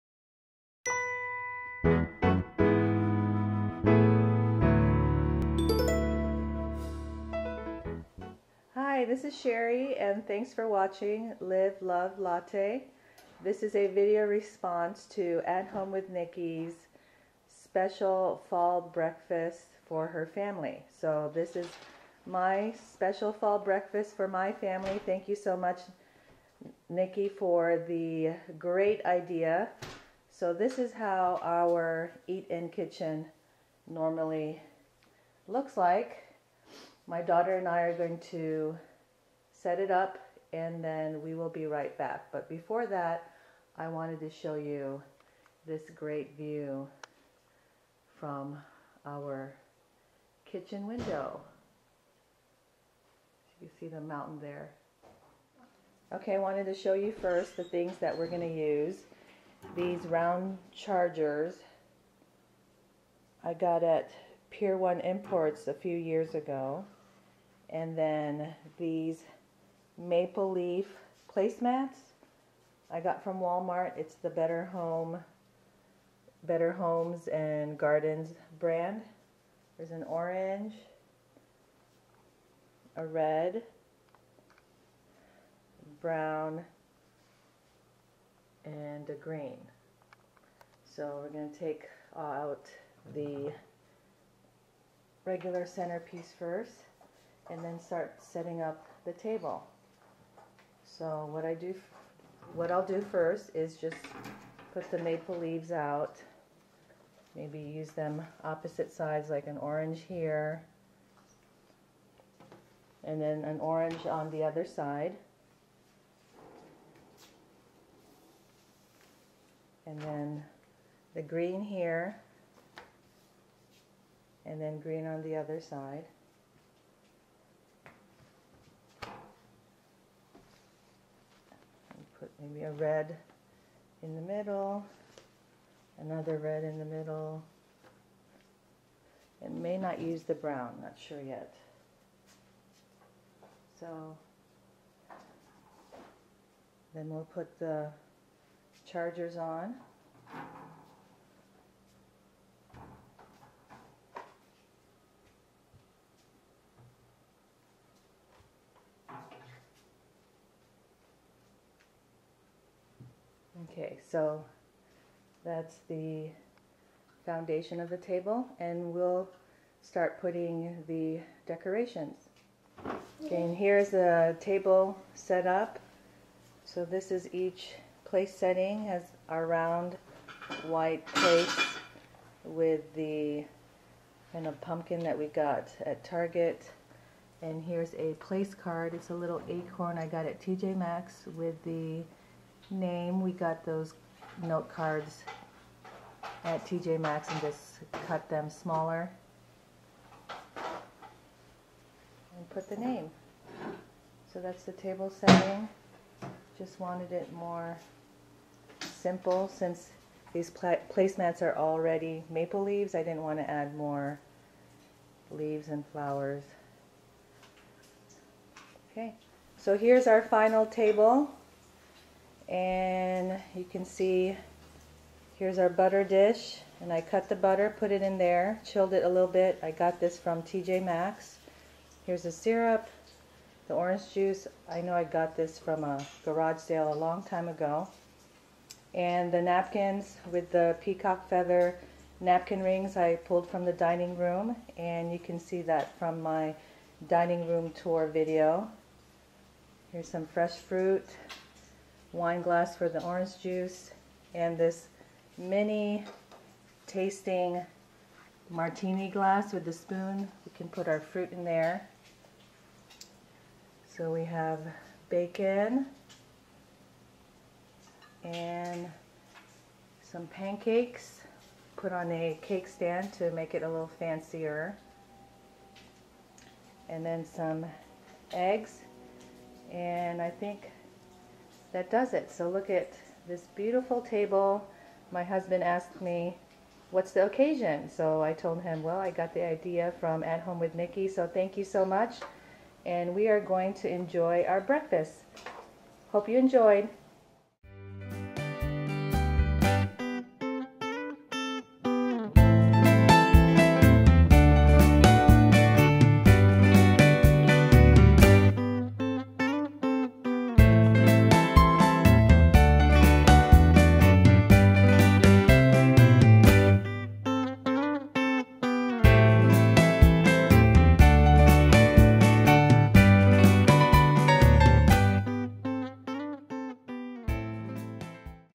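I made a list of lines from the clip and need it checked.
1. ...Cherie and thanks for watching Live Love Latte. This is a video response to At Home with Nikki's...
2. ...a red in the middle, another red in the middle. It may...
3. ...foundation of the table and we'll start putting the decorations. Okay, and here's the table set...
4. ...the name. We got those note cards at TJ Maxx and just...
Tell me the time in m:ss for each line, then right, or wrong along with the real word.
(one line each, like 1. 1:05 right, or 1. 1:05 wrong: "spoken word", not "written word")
1. 0:09 right
2. 2:12 right
3. 2:47 right
4. 3:11 right.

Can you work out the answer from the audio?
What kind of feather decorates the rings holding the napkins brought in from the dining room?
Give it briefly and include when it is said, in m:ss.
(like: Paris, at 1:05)
peacock, at 4:00.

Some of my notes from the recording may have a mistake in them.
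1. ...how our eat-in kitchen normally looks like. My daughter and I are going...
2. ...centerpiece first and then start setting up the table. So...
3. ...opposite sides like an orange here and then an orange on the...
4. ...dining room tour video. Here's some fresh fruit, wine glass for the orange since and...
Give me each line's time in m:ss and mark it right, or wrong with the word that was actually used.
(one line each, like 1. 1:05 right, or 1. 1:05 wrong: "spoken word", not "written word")
1. 0:30 right
2. 1:35 right
3. 1:48 right
4. 4:07 wrong: "juice", not "since".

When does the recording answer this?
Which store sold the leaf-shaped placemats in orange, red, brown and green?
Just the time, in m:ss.
1:13.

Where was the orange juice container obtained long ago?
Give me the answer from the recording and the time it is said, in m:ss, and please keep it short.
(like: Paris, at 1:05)
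a garage sale, at 3:56.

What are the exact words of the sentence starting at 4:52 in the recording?
And we are going to enjoy our breakfast.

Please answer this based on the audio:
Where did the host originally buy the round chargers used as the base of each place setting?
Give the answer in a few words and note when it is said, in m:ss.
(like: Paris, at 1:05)
Pier 1 Imports, at 1:04.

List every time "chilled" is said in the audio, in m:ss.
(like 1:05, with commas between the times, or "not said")
3:48.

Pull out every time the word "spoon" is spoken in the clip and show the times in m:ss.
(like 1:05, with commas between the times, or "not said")
4:19.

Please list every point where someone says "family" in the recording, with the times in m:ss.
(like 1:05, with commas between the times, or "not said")
0:20, 0:24.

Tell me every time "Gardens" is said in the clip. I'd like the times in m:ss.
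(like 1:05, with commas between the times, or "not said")
1:17.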